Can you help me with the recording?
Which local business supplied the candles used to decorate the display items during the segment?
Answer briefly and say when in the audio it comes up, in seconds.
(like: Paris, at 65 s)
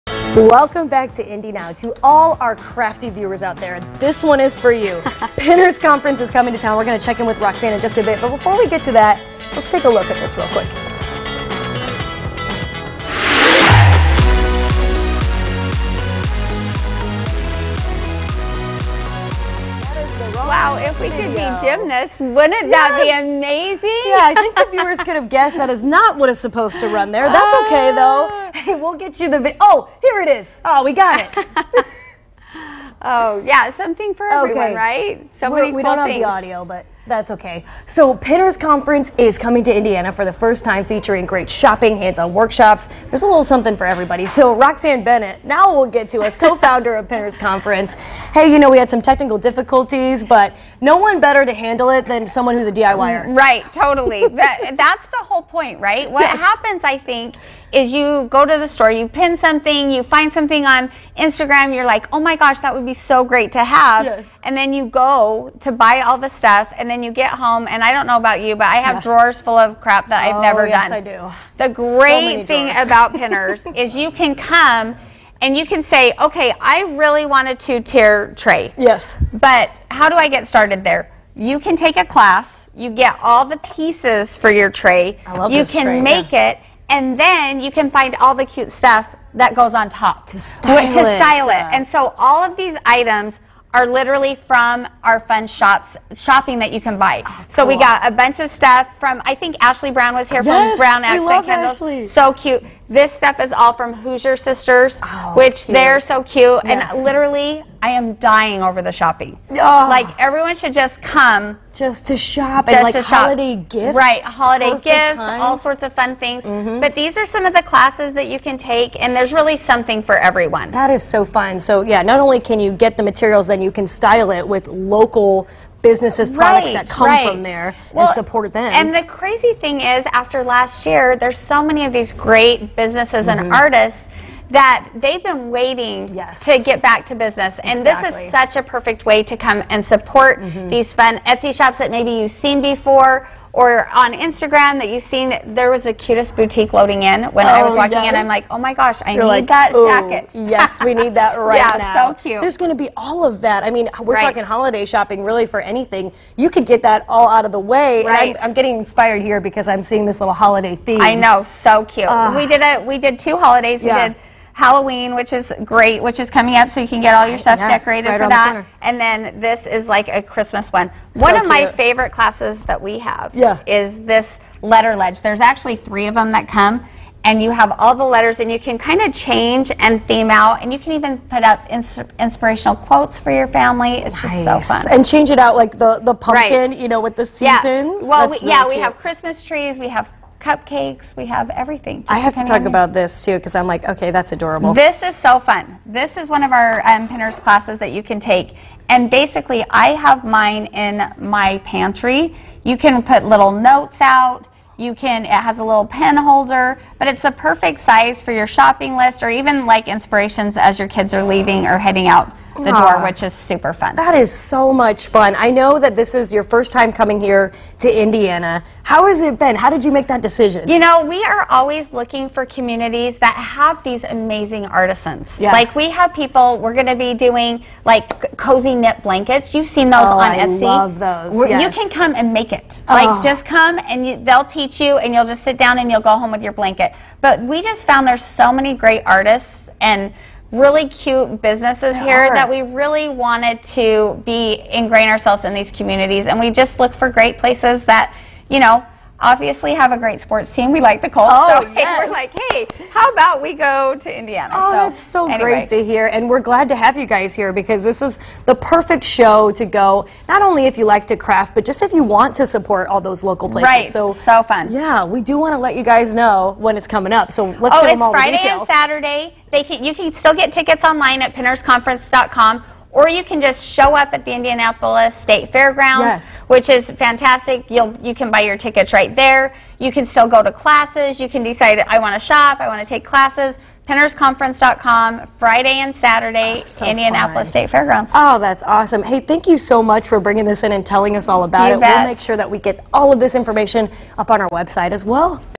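Brown Accent Candles, at 100 s.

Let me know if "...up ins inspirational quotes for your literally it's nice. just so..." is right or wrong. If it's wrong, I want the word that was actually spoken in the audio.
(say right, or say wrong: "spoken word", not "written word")
wrong: "family", not "literally".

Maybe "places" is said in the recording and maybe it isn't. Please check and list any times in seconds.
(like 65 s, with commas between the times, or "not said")
247 s, 263 s.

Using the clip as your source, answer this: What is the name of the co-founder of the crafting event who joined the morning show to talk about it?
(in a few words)
Roxanne Bennett.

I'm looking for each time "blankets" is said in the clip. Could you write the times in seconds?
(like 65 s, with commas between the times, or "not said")
229 s, 236 s.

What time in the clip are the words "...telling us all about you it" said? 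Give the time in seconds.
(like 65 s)
290 s.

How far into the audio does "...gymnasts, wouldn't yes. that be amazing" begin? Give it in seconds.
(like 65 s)
21 s.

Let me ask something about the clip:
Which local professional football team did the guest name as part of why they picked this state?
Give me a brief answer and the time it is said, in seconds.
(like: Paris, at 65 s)
The Colts, at 251 s.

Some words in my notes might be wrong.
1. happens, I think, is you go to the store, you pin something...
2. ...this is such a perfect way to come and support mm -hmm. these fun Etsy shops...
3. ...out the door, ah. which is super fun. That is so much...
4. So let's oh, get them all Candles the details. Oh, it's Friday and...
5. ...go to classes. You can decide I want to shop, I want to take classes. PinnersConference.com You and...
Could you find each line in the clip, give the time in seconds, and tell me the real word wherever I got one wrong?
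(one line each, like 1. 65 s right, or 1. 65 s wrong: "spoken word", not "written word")
1. 56 s right
2. 137 s right
3. 212 s right
4. 267 s wrong: "Friday", not "Candles"
5. 280 s wrong: "Friday", not "You".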